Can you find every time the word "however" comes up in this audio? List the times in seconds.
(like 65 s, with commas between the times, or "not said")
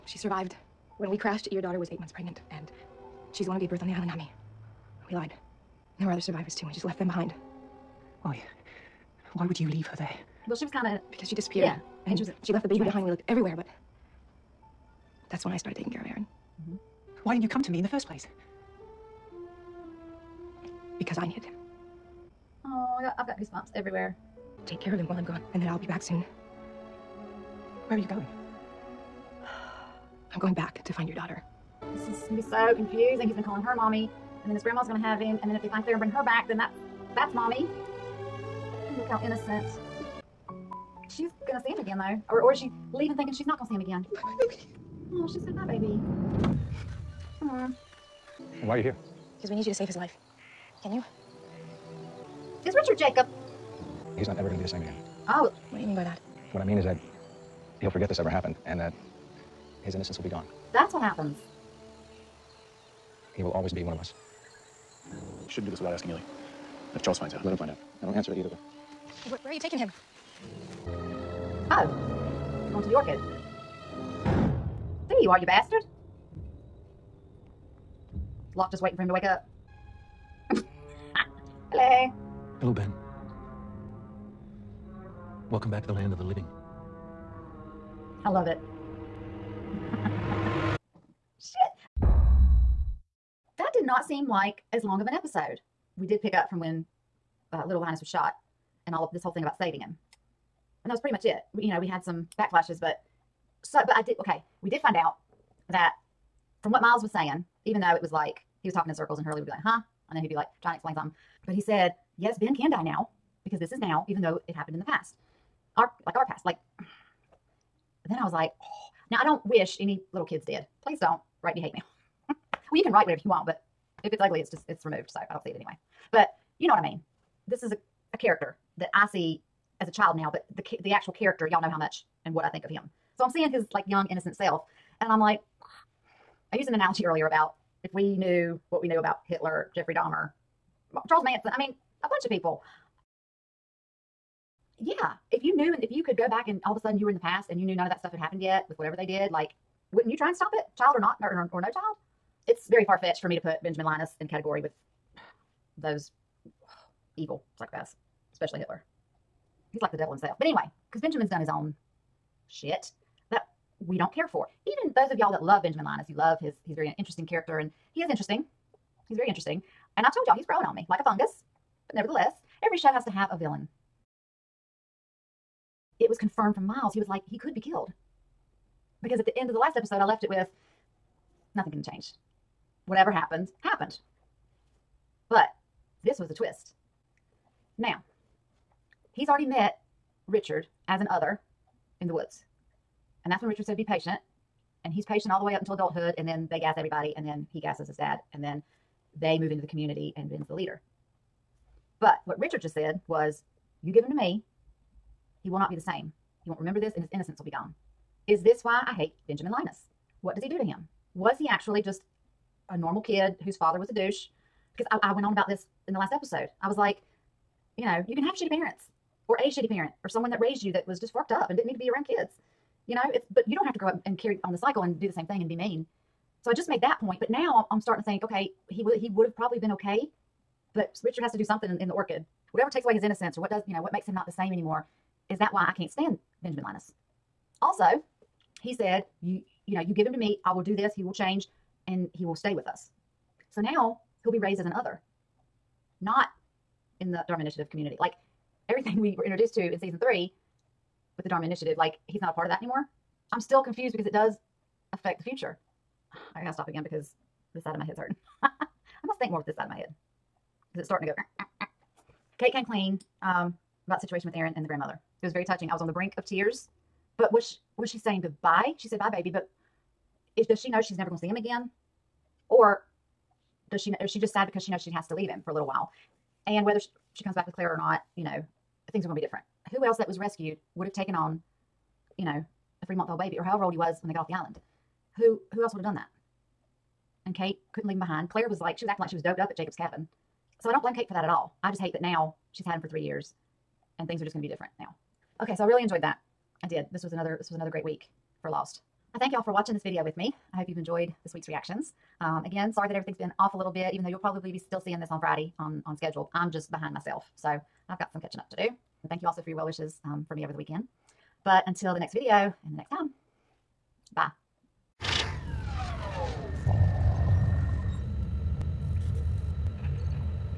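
283 s.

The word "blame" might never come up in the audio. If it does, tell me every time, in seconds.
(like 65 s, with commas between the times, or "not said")
290 s.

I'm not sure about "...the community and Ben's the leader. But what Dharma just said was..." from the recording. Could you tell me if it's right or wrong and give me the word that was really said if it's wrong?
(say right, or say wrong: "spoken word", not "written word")
wrong: "Richard", not "Dharma".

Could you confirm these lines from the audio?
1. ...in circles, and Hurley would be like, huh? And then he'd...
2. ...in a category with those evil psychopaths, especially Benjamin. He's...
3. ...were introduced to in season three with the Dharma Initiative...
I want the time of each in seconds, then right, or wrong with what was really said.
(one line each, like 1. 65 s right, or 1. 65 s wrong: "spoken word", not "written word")
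1. 108 s right
2. 154 s wrong: "Hitler", not "Benjamin"
3. 249 s right.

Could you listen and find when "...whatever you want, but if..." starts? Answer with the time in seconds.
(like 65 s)
123 s.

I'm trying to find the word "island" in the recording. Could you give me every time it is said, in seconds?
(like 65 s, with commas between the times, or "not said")
3 s, 284 s.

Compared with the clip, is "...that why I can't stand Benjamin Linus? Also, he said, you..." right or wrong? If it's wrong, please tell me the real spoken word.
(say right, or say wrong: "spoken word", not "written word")
right.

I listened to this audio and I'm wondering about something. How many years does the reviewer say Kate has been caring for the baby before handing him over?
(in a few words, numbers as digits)
3.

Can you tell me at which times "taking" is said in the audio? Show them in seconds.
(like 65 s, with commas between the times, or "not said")
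15 s, 69 s.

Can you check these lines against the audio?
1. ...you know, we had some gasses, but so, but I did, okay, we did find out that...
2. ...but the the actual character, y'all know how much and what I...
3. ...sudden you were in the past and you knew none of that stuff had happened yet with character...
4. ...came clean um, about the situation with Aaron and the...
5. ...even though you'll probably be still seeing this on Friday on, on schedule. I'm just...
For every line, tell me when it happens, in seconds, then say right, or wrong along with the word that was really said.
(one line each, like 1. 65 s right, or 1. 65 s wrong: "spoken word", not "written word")
1. 101 s wrong: "backflashes", not "gasses"
2. 130 s right
3. 146 s wrong: "whatever", not "character"
4. 262 s right
5. 303 s right.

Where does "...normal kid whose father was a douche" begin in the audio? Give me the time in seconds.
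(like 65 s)
212 s.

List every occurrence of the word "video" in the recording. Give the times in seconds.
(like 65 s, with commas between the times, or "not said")
299 s, 312 s.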